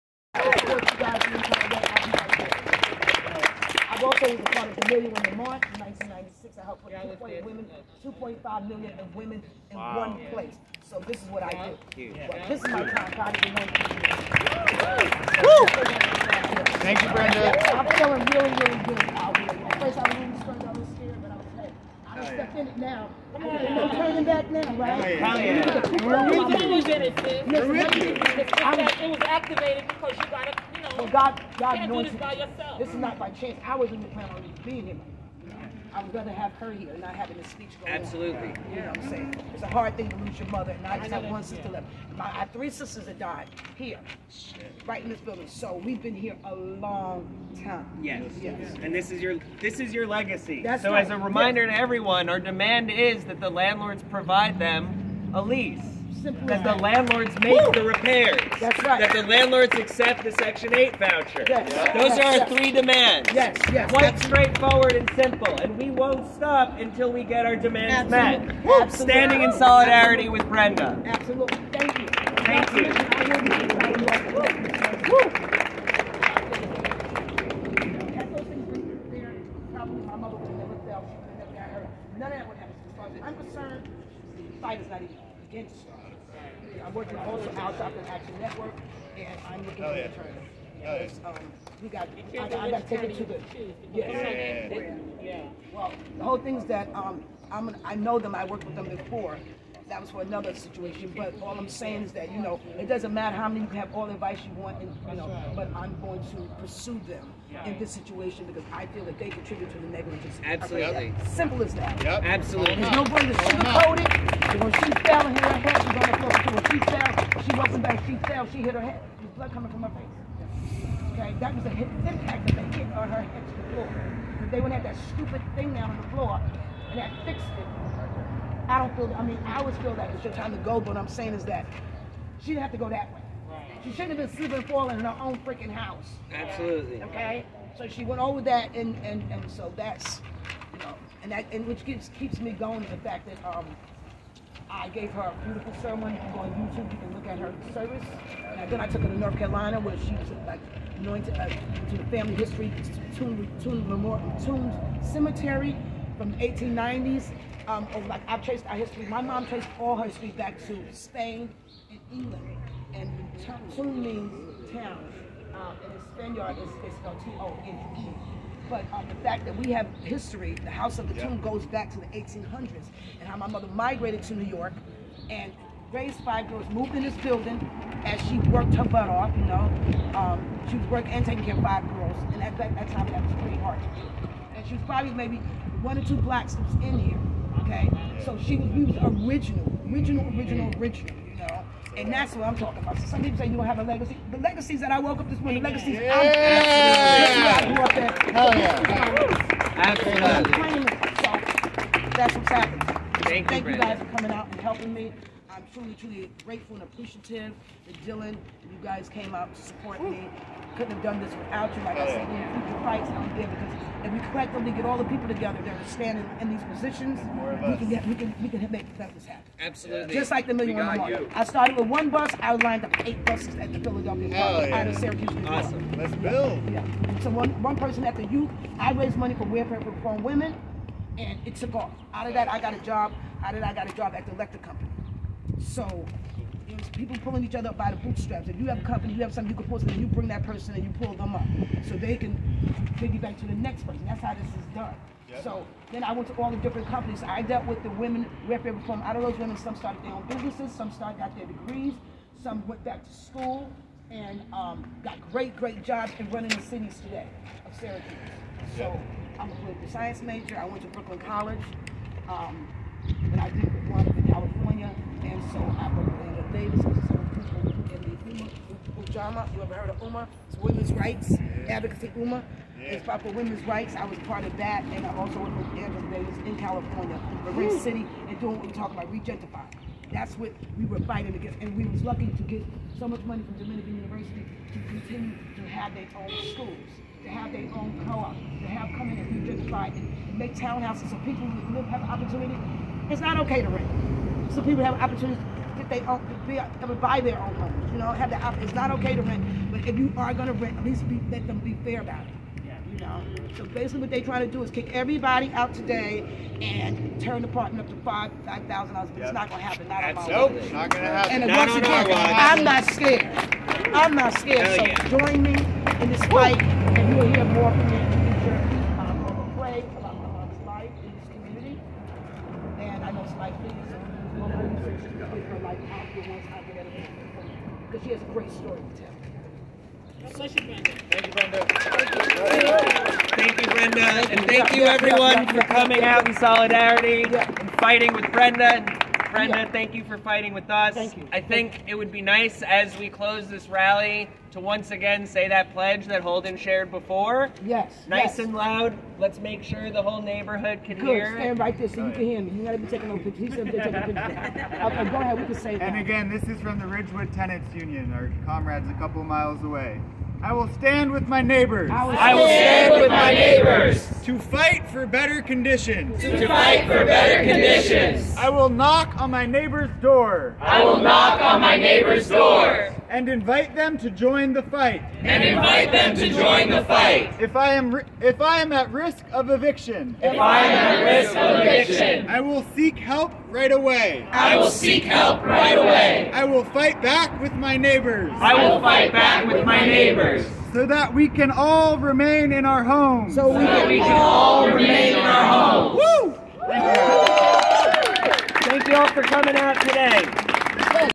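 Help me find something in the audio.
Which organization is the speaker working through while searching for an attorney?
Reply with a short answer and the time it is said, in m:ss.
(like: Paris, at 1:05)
Action Network, at 1:28.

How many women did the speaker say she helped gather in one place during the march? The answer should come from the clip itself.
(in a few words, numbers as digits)
2.5 million.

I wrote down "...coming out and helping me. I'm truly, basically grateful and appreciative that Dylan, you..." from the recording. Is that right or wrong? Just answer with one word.
wrong.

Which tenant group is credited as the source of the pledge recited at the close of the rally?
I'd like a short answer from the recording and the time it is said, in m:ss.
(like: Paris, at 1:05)
Ridgewood Tenants Union, at 5:56.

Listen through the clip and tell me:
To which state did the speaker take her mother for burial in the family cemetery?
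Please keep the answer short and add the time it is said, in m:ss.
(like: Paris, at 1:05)
North Carolina, at 2:29.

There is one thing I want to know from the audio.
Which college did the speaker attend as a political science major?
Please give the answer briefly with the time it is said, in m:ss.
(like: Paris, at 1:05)
Brooklyn College, at 4:20.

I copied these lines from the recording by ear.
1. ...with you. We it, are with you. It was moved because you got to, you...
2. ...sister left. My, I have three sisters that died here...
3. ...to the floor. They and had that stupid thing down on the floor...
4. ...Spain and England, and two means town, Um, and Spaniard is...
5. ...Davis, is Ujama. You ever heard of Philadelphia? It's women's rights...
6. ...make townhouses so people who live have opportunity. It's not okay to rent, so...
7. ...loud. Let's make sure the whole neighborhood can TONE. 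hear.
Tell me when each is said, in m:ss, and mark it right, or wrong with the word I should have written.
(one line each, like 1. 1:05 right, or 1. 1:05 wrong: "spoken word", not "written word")
1. 0:26 wrong: "activated", not "moved"
2. 0:41 right
3. 2:03 right
4. 2:40 right
5. 4:26 wrong: "Uma", not "Philadelphia"
6. 4:50 right
7. 5:48 wrong: "Good", not "TONE".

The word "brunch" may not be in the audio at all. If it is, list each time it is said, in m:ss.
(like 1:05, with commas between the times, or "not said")
not said.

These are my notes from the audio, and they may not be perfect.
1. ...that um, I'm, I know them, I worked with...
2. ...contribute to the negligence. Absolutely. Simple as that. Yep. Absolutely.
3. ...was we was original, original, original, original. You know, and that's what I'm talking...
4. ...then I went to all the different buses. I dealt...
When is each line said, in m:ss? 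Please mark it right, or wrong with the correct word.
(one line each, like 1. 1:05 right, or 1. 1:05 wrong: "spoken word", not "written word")
1. 1:36 right
2. 1:49 right
3. 3:08 right
4. 4:05 wrong: "companies", not "buses".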